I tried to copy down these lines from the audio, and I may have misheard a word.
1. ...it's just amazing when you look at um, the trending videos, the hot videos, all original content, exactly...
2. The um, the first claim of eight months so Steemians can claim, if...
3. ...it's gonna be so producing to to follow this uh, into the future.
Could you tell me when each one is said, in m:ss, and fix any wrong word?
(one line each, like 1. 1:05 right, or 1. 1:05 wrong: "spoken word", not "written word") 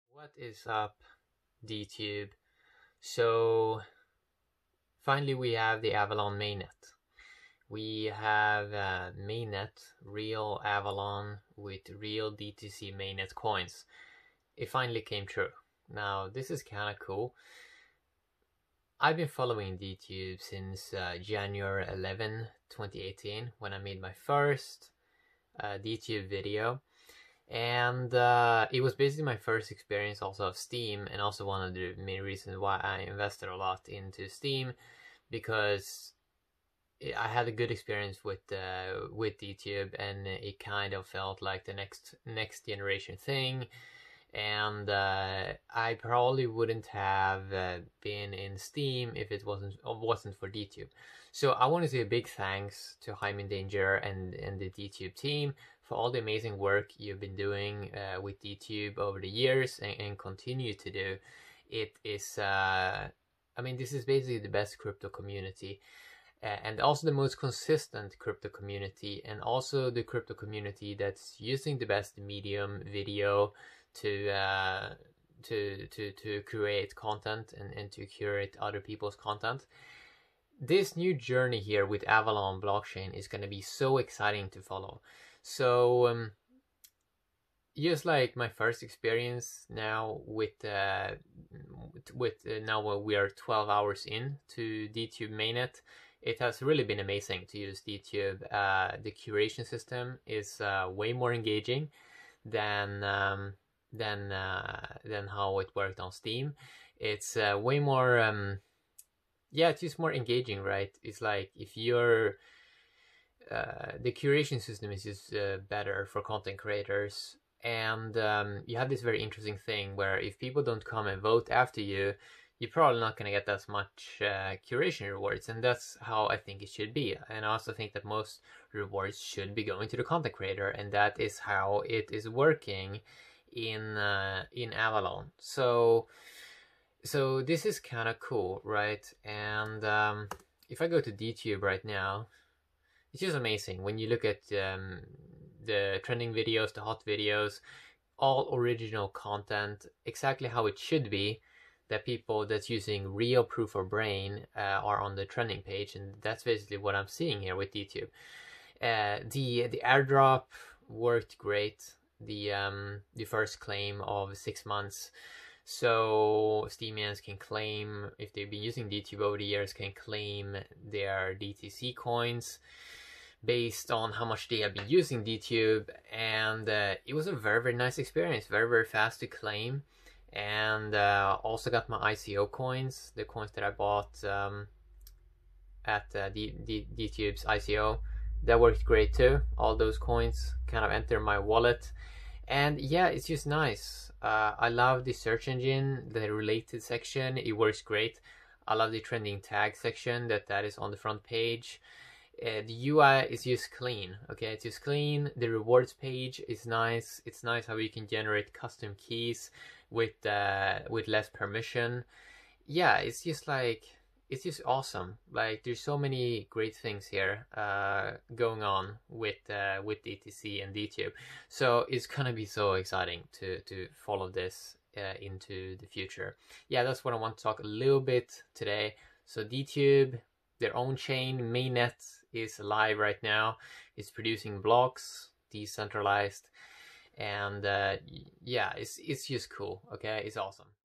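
1. 2:23 right
2. 2:42 wrong: "six", not "eight"
3. 3:41 wrong: "exciting", not "producing".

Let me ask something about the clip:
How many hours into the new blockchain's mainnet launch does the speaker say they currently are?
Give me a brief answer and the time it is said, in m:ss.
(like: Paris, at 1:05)
12 hours, at 1:33.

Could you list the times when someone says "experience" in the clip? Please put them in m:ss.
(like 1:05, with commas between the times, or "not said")
0:29, 0:37, 1:28, 2:57.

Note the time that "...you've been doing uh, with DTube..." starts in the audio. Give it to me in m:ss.
0:56.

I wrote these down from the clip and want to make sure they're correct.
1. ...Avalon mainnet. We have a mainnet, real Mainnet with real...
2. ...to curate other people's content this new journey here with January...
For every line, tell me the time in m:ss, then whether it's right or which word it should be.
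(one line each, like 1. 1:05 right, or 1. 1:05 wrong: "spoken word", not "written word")
1. 0:05 wrong: "Avalon", not "Mainnet"
2. 1:17 wrong: "Avalon", not "January".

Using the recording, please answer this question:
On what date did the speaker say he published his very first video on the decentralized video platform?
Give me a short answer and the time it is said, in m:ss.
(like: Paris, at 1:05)
January 11, 2018, at 0:21.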